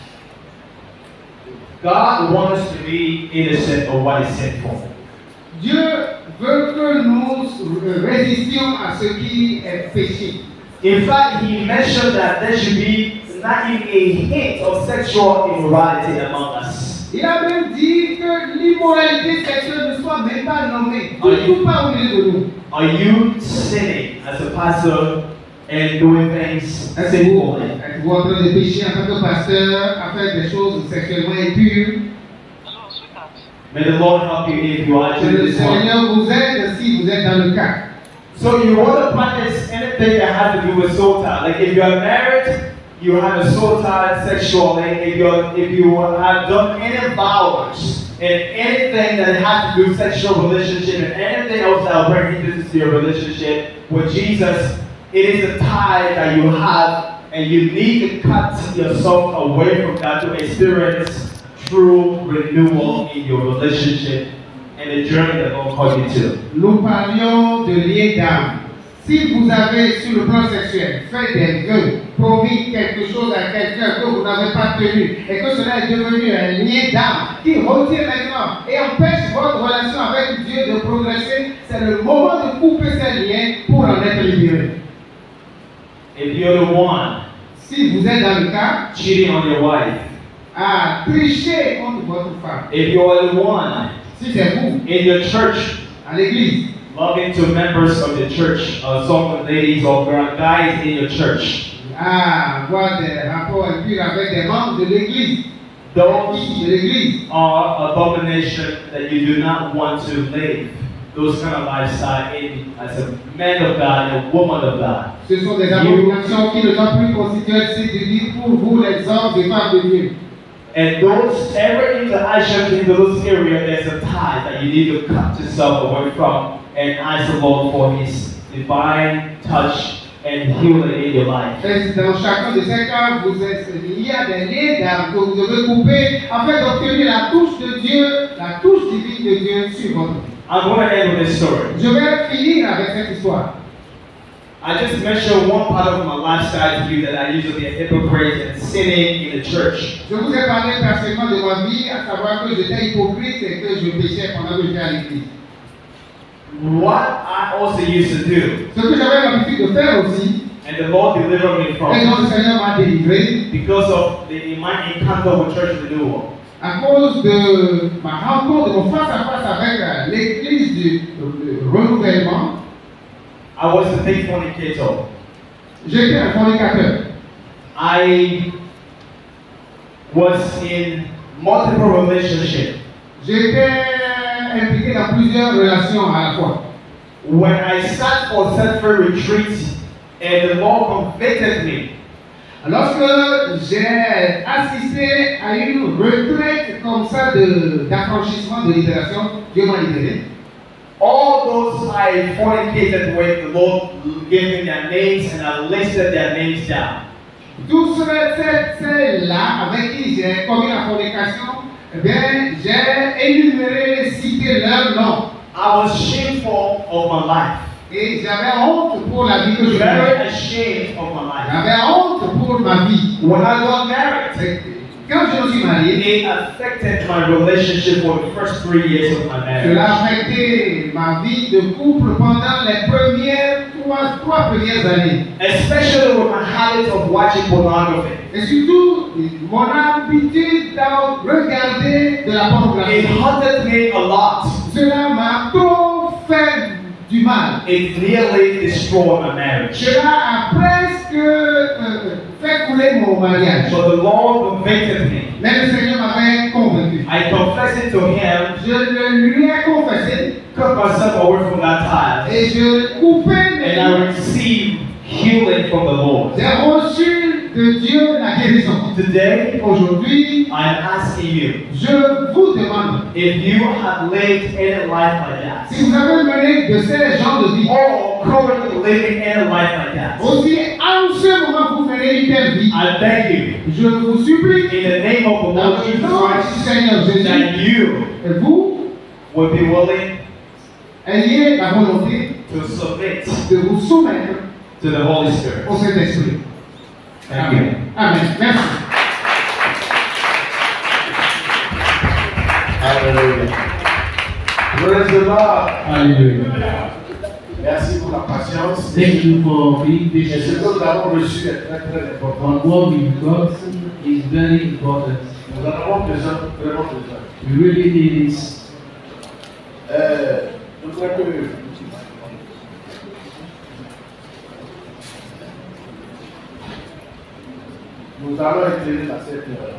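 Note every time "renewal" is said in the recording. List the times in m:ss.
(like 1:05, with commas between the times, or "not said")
1:02, 2:45.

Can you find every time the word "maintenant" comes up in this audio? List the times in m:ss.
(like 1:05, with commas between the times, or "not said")
1:18.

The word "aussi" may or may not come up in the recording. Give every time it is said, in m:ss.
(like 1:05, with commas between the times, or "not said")
2:40, 4:40.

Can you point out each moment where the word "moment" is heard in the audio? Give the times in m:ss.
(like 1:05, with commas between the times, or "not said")
1:22, 4:41.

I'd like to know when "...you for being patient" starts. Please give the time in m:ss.
5:09.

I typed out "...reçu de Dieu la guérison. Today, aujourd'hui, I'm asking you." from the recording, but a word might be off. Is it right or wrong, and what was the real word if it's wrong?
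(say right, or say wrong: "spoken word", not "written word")
right.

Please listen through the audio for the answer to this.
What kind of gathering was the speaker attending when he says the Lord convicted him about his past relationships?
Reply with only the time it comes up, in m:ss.
3:08.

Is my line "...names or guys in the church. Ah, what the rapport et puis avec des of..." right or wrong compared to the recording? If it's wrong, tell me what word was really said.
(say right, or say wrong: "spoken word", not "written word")
wrong: "ladies", not "names".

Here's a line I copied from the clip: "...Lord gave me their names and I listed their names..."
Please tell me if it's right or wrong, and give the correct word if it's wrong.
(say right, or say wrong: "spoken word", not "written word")
right.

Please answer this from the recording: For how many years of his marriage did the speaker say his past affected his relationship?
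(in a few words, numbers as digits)
3.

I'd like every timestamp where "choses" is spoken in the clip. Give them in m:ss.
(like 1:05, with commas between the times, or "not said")
0:30, 1:13.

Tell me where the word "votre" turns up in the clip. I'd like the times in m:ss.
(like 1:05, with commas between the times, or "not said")
1:19, 1:32.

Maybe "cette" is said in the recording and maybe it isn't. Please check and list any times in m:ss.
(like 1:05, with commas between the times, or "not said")
2:22, 5:29.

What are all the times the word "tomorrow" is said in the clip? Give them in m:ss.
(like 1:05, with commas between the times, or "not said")
not said.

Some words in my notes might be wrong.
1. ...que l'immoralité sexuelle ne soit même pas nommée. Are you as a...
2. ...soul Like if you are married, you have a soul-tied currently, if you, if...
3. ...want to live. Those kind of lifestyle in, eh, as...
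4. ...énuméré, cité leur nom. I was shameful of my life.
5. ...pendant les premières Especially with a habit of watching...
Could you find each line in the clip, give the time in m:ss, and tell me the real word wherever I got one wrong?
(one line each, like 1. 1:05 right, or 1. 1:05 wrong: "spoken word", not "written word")
1. 0:18 right
2. 0:40 wrong: "sexually", not "currently"
3. 1:49 right
4. 3:33 right
5. 3:52 right.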